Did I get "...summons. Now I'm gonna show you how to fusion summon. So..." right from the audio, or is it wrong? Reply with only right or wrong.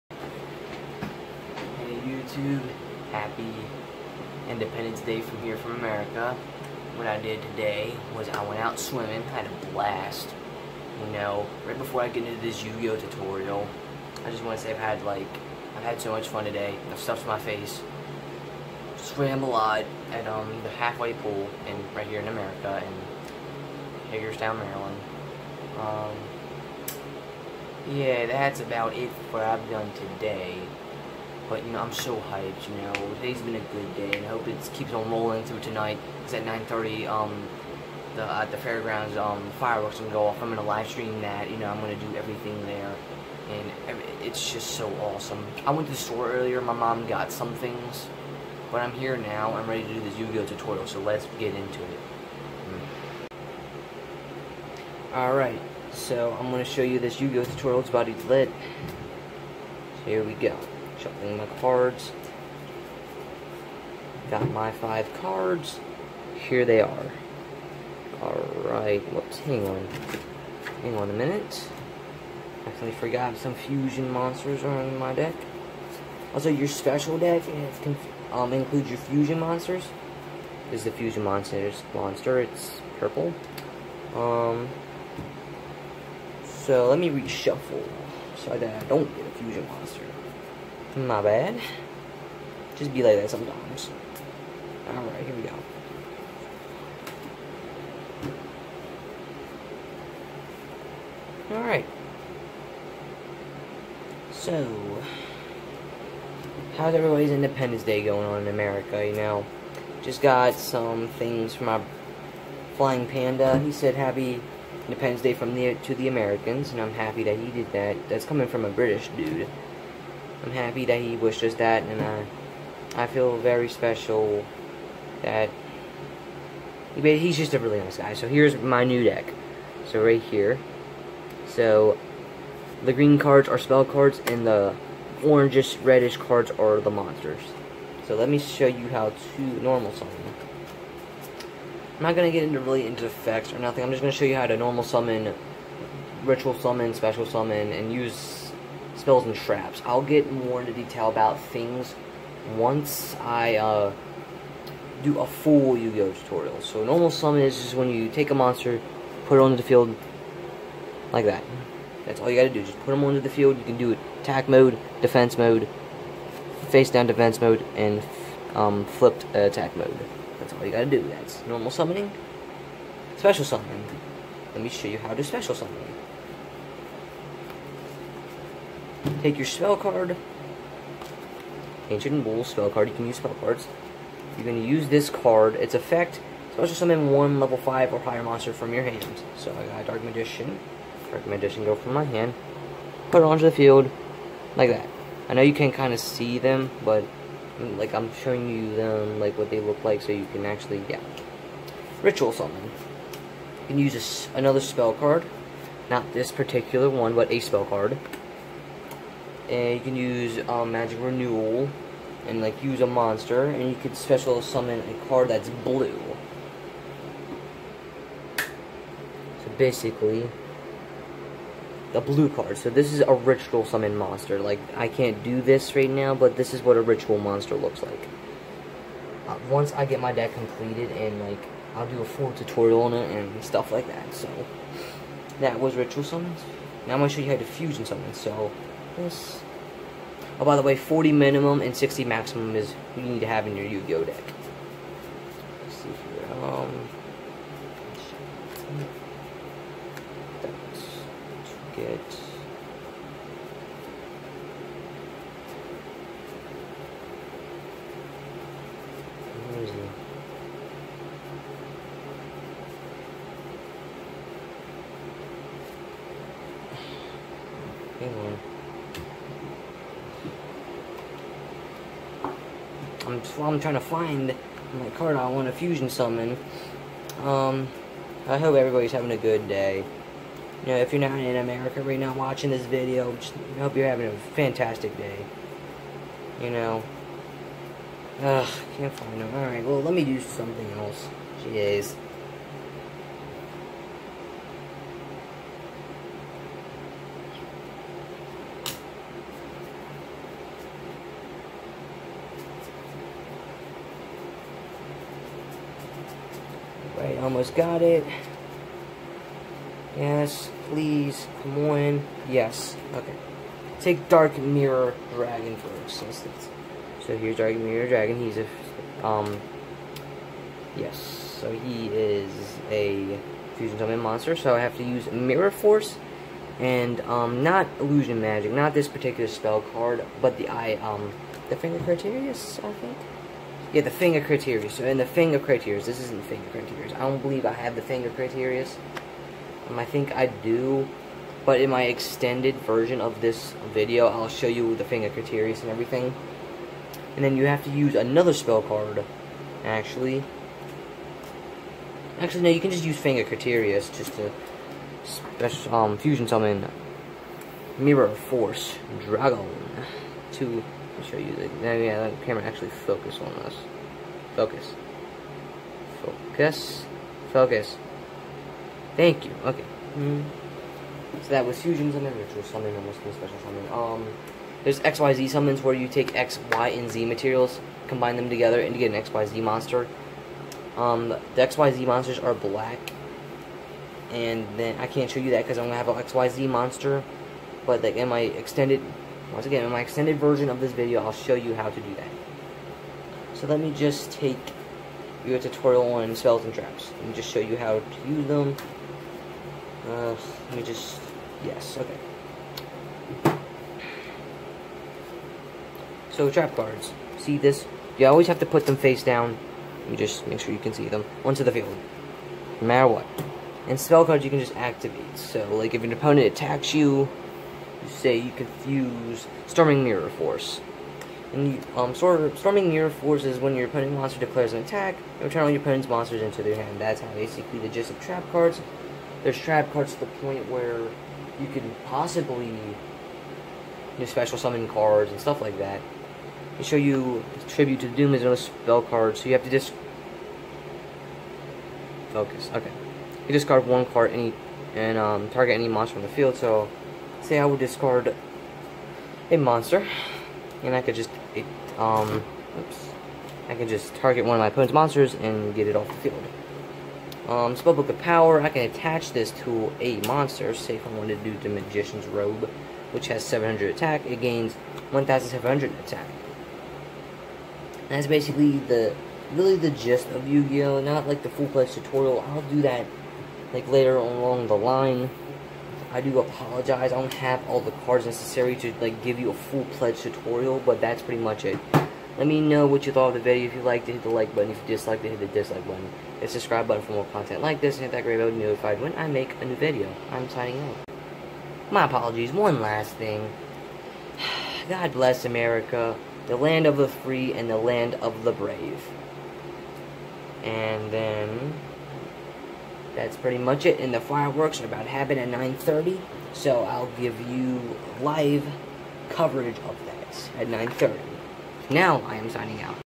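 right.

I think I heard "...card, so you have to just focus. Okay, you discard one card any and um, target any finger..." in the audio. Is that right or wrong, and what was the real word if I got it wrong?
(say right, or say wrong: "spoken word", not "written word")
wrong: "monster", not "finger".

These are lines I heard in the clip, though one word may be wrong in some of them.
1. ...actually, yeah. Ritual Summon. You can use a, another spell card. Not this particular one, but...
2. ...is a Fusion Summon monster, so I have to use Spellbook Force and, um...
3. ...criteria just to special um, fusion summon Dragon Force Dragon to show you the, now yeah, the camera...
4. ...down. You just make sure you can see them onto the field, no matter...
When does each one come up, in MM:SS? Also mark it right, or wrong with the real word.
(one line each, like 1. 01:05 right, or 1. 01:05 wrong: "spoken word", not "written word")
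1. 03:20 right
2. 05:21 wrong: "Mirror", not "Spellbook"
3. 05:53 wrong: "Mirror", not "Dragon"
4. 06:49 right.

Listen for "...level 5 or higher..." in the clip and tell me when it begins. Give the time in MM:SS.
03:07.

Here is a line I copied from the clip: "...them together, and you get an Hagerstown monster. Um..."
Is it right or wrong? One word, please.
wrong.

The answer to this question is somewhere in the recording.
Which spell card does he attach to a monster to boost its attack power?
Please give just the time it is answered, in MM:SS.
07:37.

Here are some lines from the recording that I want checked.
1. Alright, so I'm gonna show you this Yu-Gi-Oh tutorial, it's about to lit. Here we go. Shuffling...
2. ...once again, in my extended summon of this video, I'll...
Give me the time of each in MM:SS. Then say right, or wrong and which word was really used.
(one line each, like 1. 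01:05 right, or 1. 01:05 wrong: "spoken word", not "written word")
1. 00:55 right
2. 06:29 wrong: "version", not "summon".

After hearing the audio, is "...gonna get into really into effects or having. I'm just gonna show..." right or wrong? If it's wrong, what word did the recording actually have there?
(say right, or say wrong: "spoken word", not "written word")
wrong: "nothing", not "having".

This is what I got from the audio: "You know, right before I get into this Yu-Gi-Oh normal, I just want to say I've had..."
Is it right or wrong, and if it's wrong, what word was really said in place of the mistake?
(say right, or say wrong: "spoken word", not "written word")
wrong: "tutorial", not "normal".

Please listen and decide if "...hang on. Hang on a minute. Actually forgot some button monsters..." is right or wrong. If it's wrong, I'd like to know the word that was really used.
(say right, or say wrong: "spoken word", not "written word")
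wrong: "fusion", not "button".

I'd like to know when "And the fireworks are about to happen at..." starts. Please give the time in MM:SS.
08:23.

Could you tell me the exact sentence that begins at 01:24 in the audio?
Um, so let me reshuffle so that I don't get a fusion monster.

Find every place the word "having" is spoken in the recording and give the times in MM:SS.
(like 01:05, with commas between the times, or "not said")
04:38, 04:43.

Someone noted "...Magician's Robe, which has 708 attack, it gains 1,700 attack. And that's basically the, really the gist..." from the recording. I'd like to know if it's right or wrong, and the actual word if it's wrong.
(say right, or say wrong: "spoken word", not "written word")
wrong: "700", not "708".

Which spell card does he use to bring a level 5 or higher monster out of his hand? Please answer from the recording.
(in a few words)
Ancient Rules.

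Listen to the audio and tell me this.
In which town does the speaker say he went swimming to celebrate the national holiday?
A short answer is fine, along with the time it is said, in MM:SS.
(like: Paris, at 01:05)
Hagerstown, at 00:24.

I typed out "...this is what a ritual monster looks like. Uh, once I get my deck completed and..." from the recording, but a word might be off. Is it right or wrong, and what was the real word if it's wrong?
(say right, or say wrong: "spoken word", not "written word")
right.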